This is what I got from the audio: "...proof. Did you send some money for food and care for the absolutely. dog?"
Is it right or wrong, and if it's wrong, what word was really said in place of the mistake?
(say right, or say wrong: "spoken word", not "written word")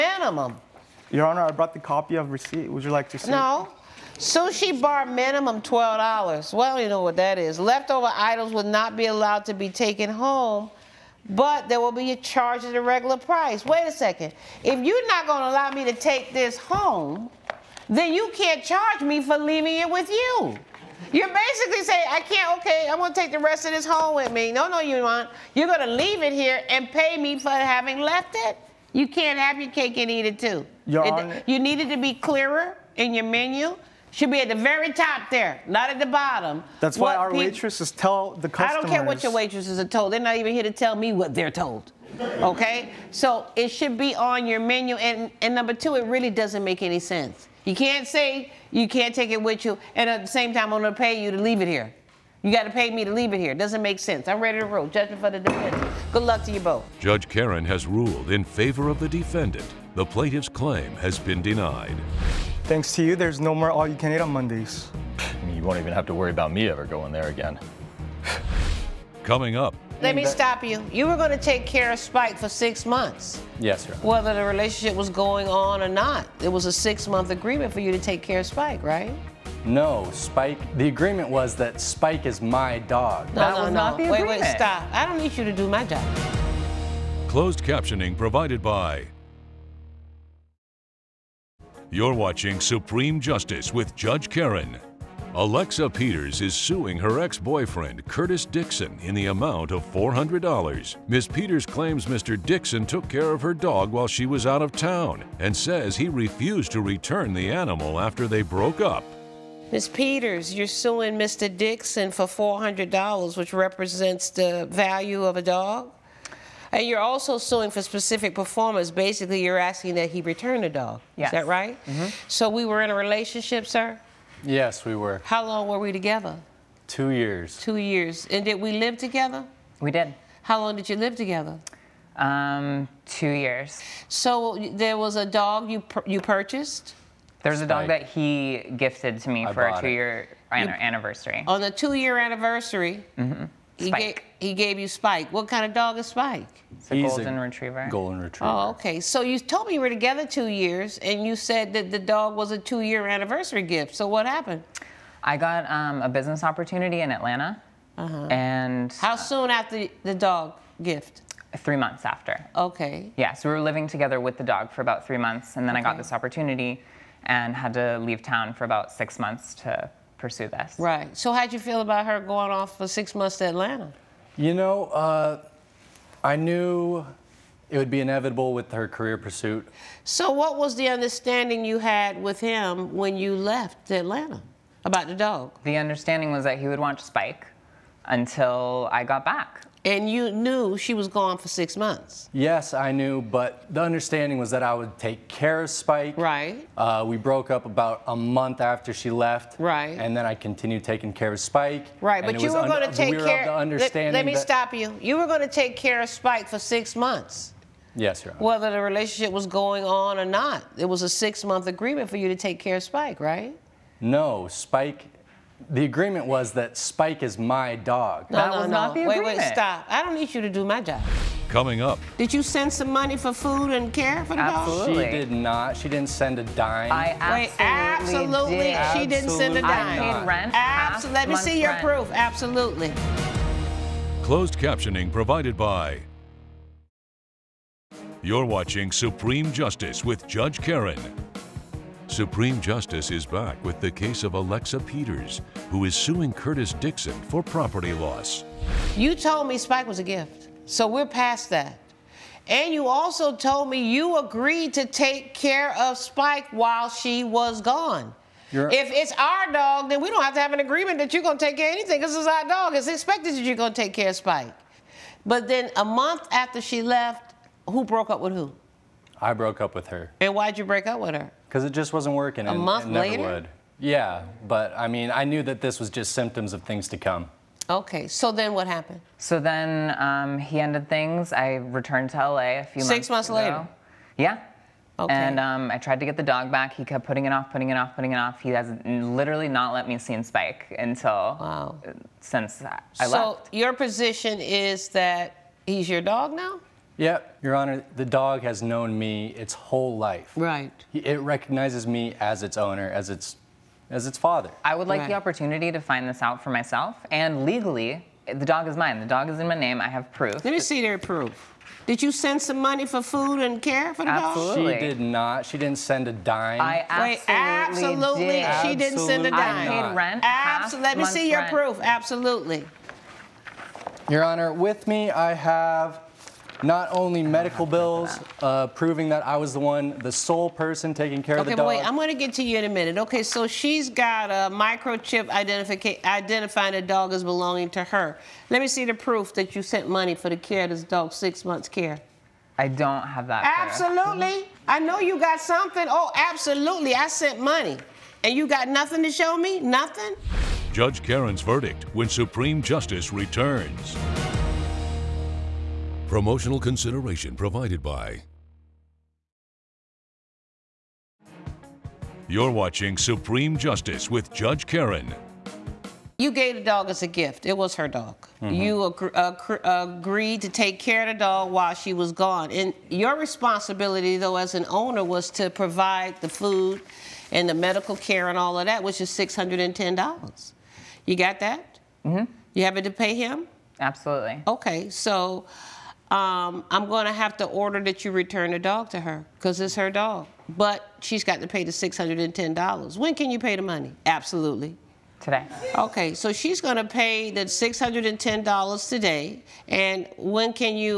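right.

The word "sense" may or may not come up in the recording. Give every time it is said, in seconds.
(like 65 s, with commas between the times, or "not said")
46 s, 53 s.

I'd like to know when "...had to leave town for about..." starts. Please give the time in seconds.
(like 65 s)
167 s.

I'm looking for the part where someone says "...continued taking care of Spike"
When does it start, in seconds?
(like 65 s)
200 s.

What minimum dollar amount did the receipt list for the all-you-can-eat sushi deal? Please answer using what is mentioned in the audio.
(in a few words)
$12.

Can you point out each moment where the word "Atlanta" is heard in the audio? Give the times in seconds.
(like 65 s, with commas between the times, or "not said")
157 s, 173 s, 183 s.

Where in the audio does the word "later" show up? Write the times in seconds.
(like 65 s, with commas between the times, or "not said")
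272 s, 283 s.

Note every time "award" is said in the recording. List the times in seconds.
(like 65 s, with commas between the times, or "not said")
not said.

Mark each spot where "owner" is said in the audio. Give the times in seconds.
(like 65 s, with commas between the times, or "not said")
302 s, 374 s.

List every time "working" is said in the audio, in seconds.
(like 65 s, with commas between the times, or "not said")
272 s.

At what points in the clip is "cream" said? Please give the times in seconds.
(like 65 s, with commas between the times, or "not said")
not said.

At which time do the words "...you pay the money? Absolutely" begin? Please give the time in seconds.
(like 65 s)
393 s.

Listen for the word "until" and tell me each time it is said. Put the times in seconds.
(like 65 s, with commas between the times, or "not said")
188 s, 290 s.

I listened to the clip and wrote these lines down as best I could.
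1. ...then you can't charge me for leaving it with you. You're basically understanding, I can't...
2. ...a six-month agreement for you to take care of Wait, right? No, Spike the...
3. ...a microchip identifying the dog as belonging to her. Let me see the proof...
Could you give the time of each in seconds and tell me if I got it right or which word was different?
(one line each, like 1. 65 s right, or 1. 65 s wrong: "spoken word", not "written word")
1. 17 s wrong: "saying", not "understanding"
2. 211 s wrong: "Spike", not "Wait"
3. 334 s right.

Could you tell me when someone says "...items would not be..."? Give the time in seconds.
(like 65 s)
8 s.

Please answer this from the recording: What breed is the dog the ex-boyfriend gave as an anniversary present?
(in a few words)
golden retriever.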